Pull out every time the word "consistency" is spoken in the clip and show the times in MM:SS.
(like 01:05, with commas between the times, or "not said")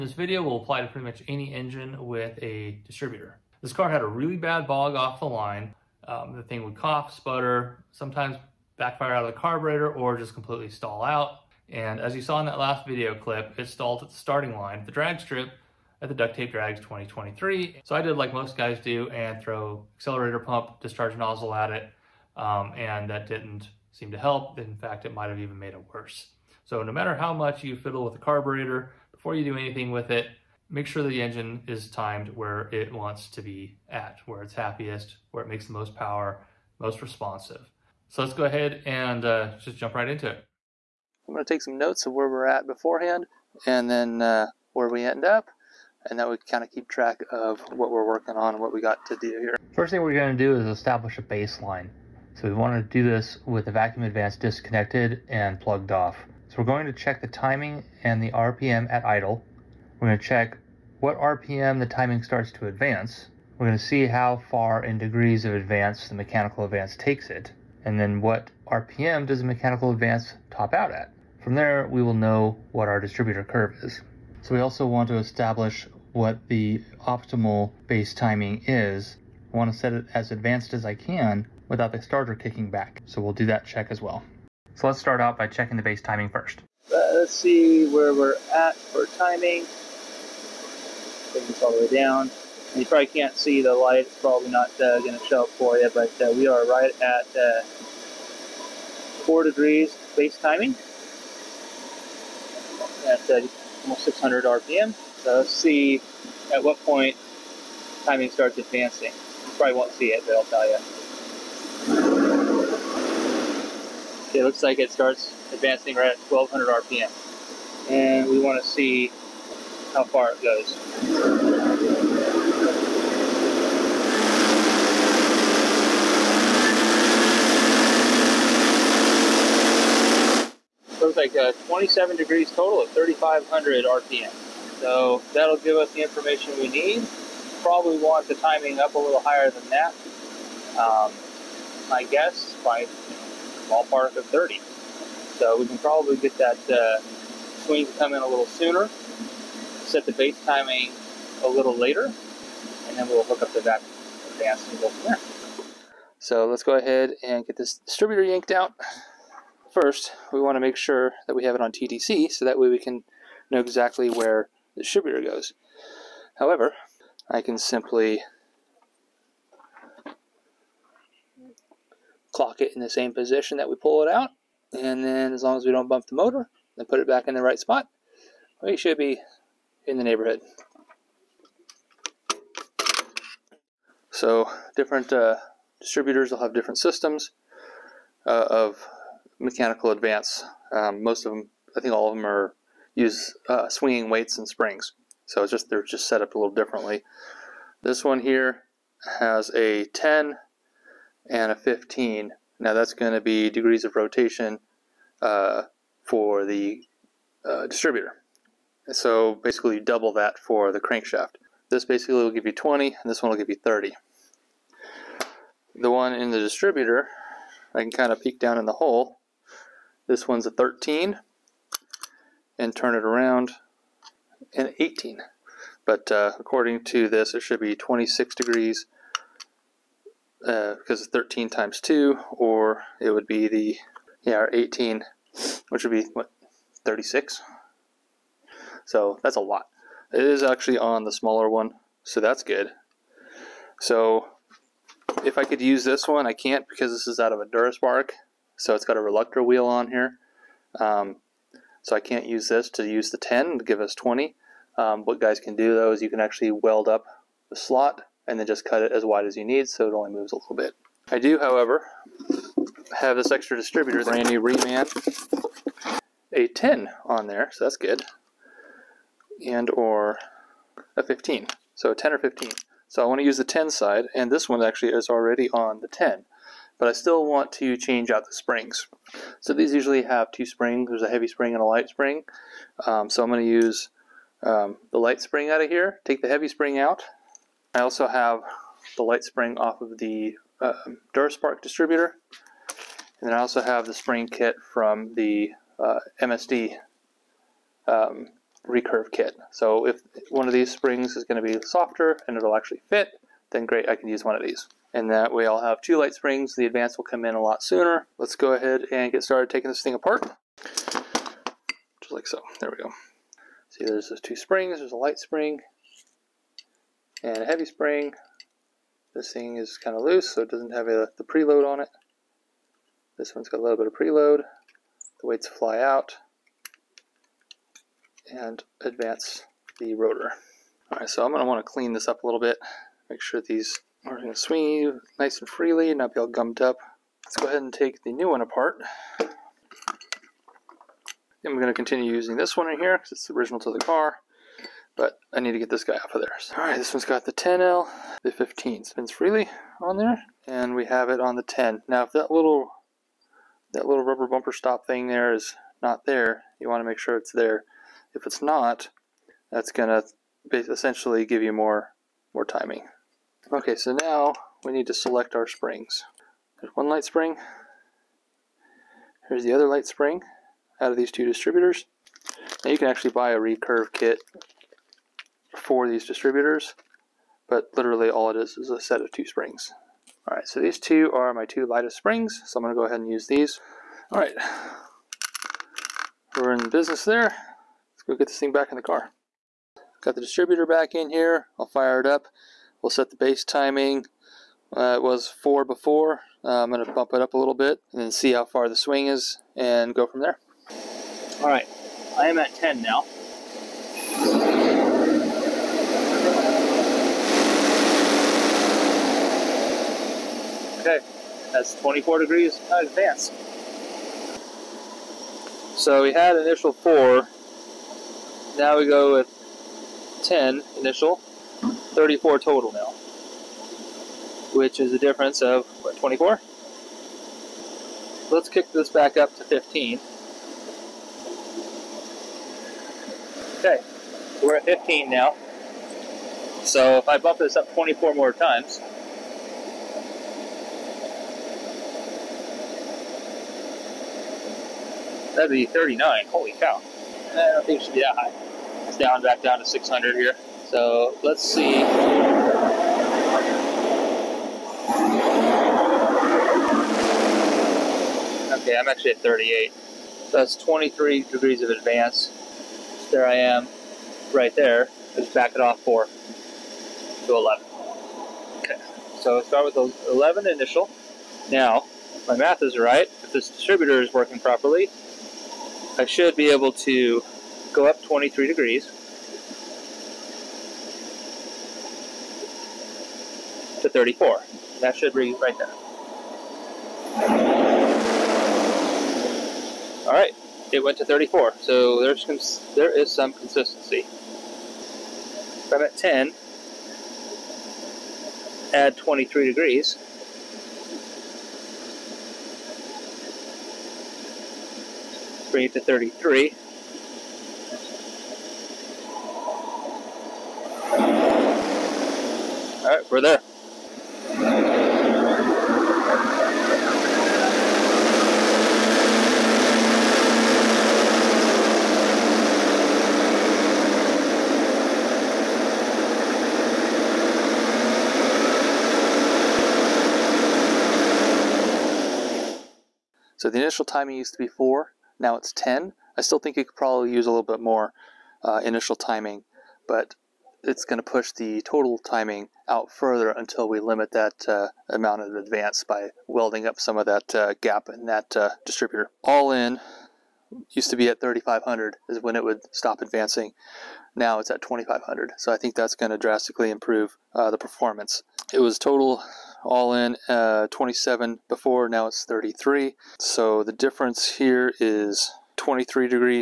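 08:13.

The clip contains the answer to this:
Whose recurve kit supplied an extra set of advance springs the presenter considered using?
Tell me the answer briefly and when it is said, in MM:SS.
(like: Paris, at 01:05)
MSD, at 04:56.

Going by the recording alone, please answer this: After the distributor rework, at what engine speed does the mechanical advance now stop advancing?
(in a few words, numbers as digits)
2500.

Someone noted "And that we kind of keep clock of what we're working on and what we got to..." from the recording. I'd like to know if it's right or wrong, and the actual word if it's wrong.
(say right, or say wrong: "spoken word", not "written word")
wrong: "track", not "clock".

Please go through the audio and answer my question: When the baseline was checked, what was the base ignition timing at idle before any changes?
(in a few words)
4 degrees.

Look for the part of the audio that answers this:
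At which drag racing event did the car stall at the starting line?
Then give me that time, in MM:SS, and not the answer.
00:16.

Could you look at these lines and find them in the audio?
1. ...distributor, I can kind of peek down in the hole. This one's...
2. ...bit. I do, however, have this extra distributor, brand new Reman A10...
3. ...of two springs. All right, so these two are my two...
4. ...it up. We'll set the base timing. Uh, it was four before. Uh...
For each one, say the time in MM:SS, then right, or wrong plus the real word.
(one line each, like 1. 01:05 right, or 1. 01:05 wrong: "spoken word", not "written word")
1. 03:36 right
2. 04:20 right
3. 06:19 right
4. 06:31 right.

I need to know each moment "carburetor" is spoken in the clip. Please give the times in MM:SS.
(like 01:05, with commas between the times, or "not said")
00:09, 00:28.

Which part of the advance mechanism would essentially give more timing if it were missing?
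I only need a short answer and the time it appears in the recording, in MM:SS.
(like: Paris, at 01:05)
rubber bumper stop, at 05:54.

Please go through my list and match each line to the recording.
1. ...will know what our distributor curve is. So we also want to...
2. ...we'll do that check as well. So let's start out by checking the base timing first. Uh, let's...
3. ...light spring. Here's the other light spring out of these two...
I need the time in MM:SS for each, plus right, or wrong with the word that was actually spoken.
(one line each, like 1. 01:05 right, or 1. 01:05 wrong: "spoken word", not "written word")
1. 01:12 right
2. 01:23 right
3. 06:06 right.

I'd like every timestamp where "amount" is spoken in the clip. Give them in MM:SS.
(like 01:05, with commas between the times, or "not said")
09:04.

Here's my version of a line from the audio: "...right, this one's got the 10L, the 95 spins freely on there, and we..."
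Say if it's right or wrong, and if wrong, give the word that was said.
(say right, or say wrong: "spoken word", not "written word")
wrong: "15", not "95".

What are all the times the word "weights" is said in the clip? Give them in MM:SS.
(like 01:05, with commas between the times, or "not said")
03:14, 05:25.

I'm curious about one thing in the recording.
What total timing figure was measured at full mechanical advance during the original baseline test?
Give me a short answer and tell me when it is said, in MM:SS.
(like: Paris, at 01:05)
27 degrees, at 02:11.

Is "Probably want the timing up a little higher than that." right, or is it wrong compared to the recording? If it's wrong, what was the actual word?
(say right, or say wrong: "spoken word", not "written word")
right.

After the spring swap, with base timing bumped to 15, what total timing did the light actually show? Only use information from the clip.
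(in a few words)
38.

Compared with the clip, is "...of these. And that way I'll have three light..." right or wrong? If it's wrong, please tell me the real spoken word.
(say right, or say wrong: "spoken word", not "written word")
wrong: "two", not "three".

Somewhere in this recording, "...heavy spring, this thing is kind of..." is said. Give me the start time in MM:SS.
05:17.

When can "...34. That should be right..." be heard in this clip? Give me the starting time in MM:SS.
08:03.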